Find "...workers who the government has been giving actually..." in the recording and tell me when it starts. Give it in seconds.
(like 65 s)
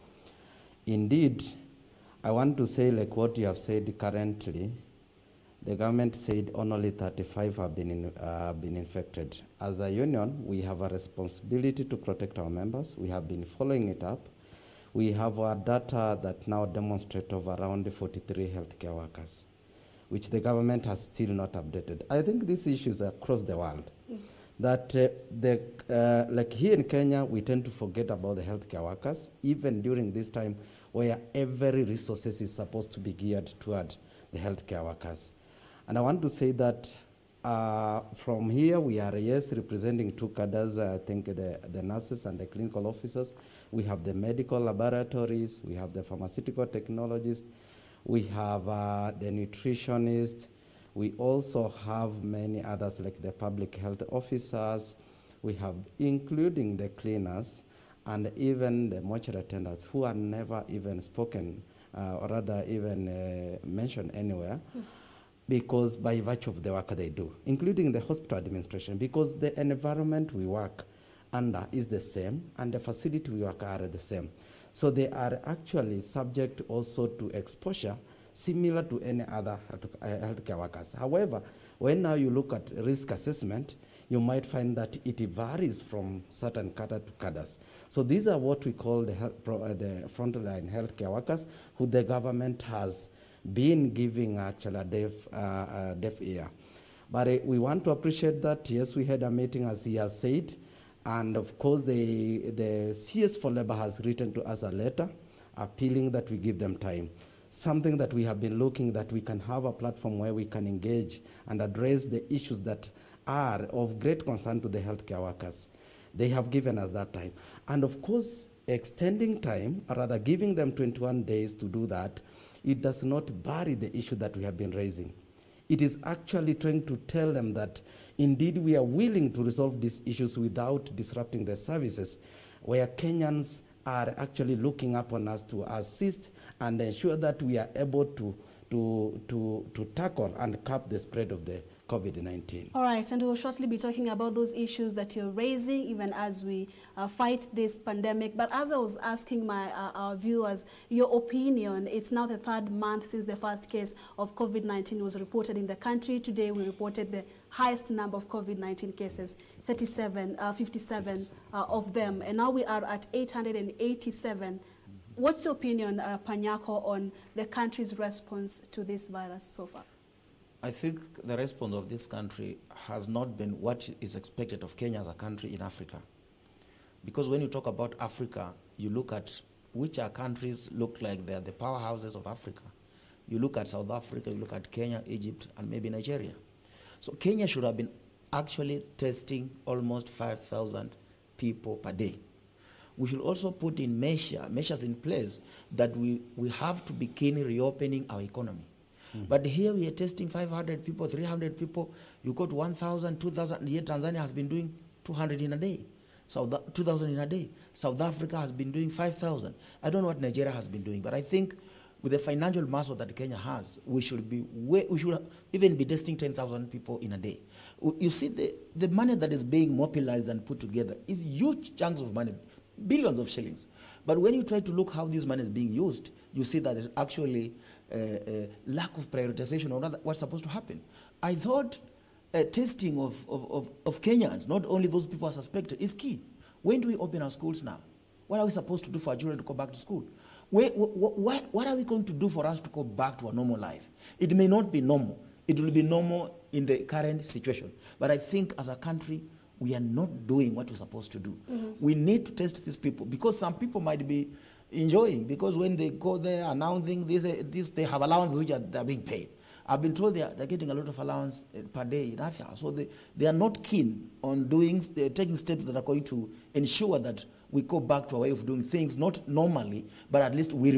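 91 s.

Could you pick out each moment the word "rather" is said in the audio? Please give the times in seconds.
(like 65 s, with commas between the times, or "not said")
62 s, 119 s.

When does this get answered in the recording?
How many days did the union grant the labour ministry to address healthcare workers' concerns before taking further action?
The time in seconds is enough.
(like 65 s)
120 s.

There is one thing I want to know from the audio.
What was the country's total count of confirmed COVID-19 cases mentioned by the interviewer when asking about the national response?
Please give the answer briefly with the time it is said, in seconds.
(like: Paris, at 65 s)
887, at 163 s.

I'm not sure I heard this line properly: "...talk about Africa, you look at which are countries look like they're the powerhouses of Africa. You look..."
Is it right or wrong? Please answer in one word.
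right.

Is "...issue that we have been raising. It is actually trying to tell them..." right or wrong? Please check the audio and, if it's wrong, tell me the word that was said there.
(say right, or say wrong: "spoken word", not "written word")
right.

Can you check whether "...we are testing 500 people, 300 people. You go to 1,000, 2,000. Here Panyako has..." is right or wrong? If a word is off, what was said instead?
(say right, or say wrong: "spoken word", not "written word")
wrong: "Tanzania", not "Panyako".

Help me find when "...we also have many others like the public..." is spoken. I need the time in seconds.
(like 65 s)
50 s.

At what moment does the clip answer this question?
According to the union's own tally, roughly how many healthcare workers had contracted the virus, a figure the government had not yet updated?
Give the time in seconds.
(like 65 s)
17 s.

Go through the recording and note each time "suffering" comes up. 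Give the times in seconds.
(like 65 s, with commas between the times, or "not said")
not said.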